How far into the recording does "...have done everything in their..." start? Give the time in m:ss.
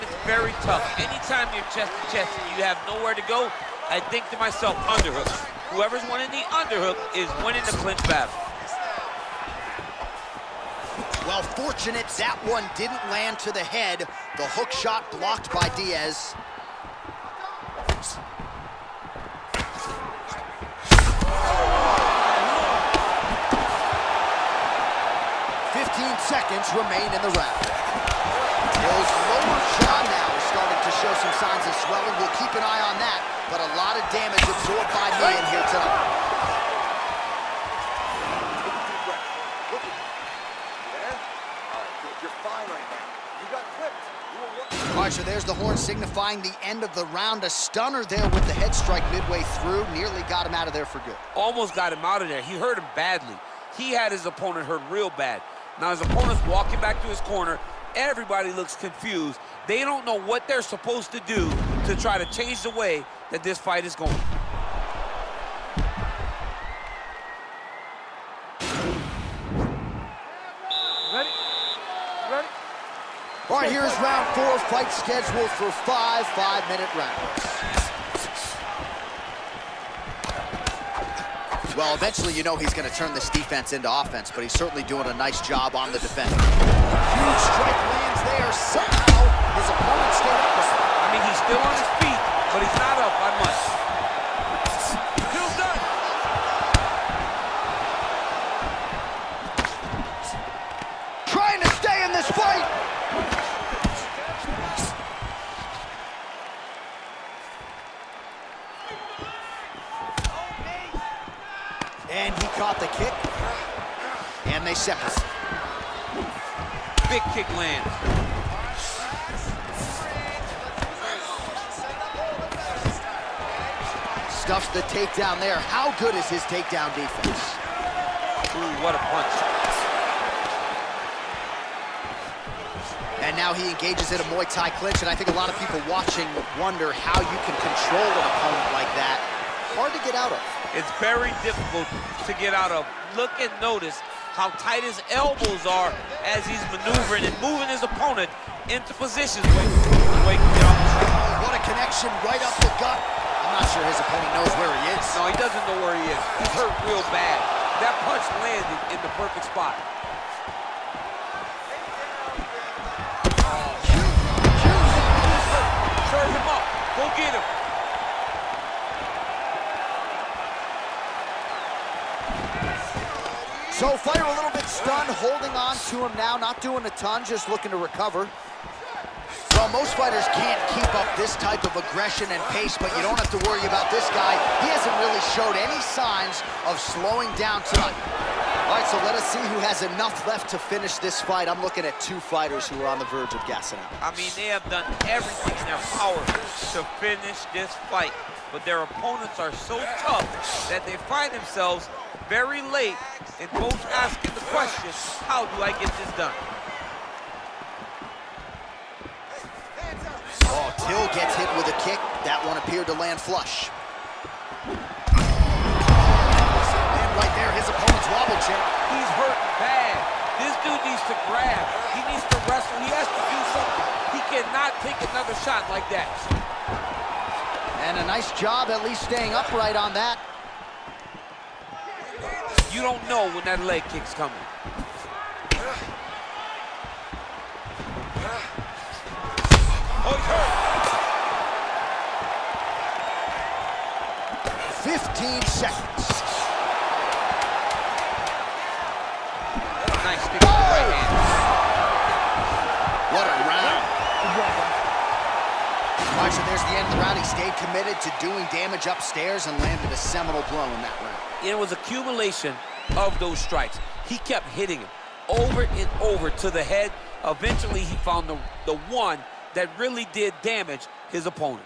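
3:14.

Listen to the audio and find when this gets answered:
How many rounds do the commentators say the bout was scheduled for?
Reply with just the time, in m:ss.
1:15.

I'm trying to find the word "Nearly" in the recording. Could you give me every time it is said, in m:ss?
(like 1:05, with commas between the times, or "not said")
0:49.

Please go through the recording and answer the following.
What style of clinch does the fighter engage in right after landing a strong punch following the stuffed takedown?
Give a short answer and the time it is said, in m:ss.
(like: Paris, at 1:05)
Muay Thai clinch, at 2:14.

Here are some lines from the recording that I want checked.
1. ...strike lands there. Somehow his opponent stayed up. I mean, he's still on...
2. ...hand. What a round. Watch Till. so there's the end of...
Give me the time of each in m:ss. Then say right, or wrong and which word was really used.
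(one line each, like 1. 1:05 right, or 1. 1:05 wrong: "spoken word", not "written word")
1. 1:27 right
2. 4:10 wrong: "Right", not "Till".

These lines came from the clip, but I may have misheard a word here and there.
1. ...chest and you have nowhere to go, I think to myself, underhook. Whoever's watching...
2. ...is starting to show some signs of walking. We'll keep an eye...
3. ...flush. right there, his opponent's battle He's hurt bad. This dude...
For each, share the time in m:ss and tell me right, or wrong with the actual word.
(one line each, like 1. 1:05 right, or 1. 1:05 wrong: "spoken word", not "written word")
1. 0:02 wrong: "winning", not "watching"
2. 0:30 wrong: "swelling", not "walking"
3. 3:33 wrong: "wobble", not "battle".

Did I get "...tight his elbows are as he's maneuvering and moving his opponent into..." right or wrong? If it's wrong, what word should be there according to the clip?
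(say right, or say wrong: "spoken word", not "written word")
right.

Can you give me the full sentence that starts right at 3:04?
He hasn't really showed any signs of slowing down tonight.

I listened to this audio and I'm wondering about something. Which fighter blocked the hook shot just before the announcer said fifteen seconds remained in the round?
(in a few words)
Diaz.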